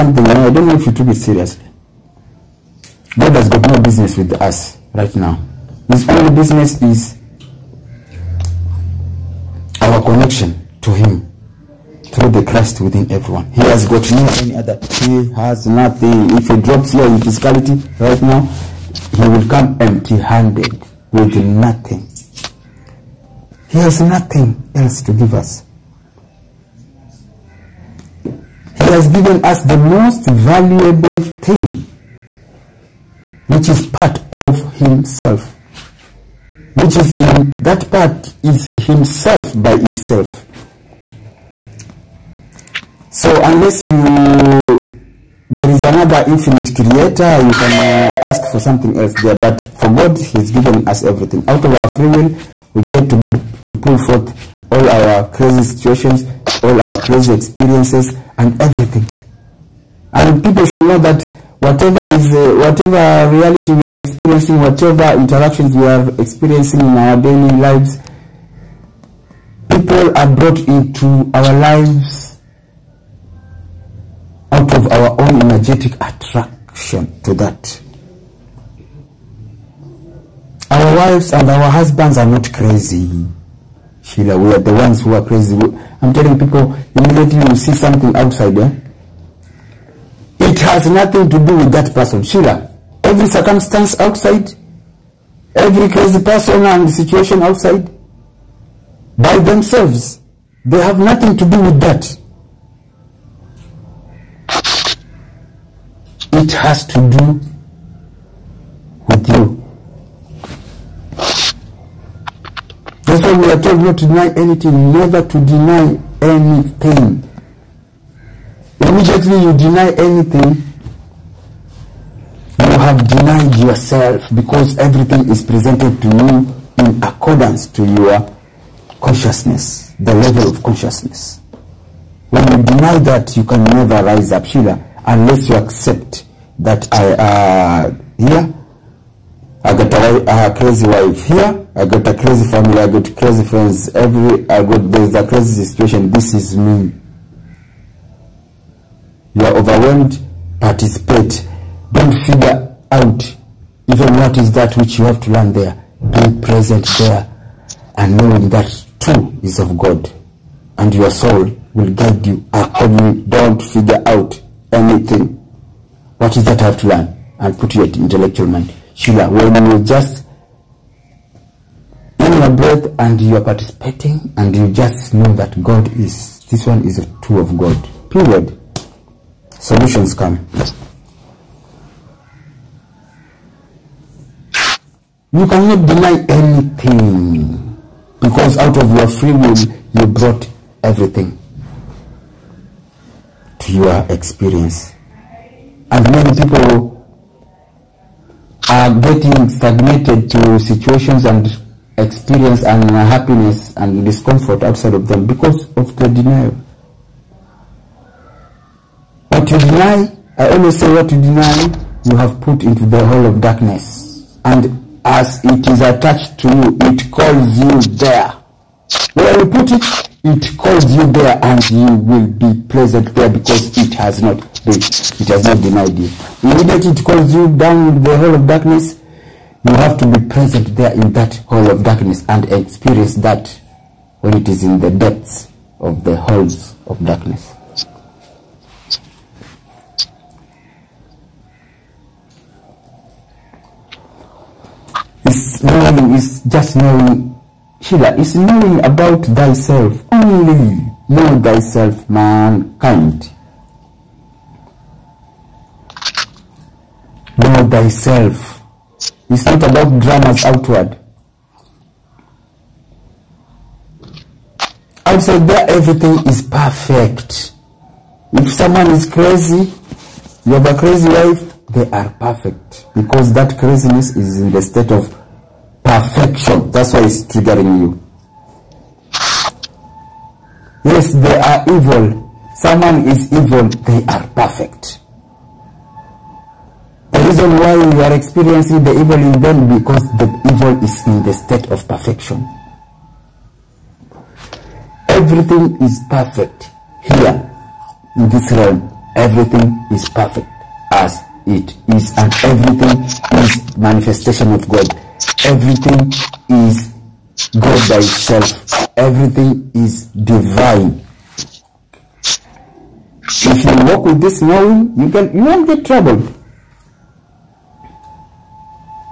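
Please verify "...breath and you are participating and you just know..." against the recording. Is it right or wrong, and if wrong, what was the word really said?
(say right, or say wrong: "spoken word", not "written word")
right.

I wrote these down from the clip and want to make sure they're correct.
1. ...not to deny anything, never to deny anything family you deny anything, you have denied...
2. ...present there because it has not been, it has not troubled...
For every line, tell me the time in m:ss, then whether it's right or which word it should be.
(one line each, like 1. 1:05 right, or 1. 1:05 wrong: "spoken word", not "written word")
1. 1:53 wrong: "immediately", not "family"
2. 3:42 wrong: "denied", not "troubled".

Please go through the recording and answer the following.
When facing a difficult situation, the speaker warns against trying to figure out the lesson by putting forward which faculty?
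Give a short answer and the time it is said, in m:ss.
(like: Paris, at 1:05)
intellectual mind, at 2:47.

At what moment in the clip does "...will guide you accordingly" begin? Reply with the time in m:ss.
2:41.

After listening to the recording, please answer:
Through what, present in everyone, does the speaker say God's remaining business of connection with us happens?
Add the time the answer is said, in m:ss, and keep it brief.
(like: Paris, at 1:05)
the Christ, at 0:12.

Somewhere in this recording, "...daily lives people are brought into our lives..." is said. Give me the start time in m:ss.
1:07.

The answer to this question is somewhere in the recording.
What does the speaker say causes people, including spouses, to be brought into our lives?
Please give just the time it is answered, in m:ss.
1:15.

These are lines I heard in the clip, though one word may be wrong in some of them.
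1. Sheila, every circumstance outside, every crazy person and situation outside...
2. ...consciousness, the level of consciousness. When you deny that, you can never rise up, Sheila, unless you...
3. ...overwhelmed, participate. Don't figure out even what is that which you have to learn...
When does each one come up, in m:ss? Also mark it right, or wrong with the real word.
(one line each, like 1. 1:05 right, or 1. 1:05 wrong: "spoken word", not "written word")
1. 1:32 right
2. 2:09 right
3. 2:29 right.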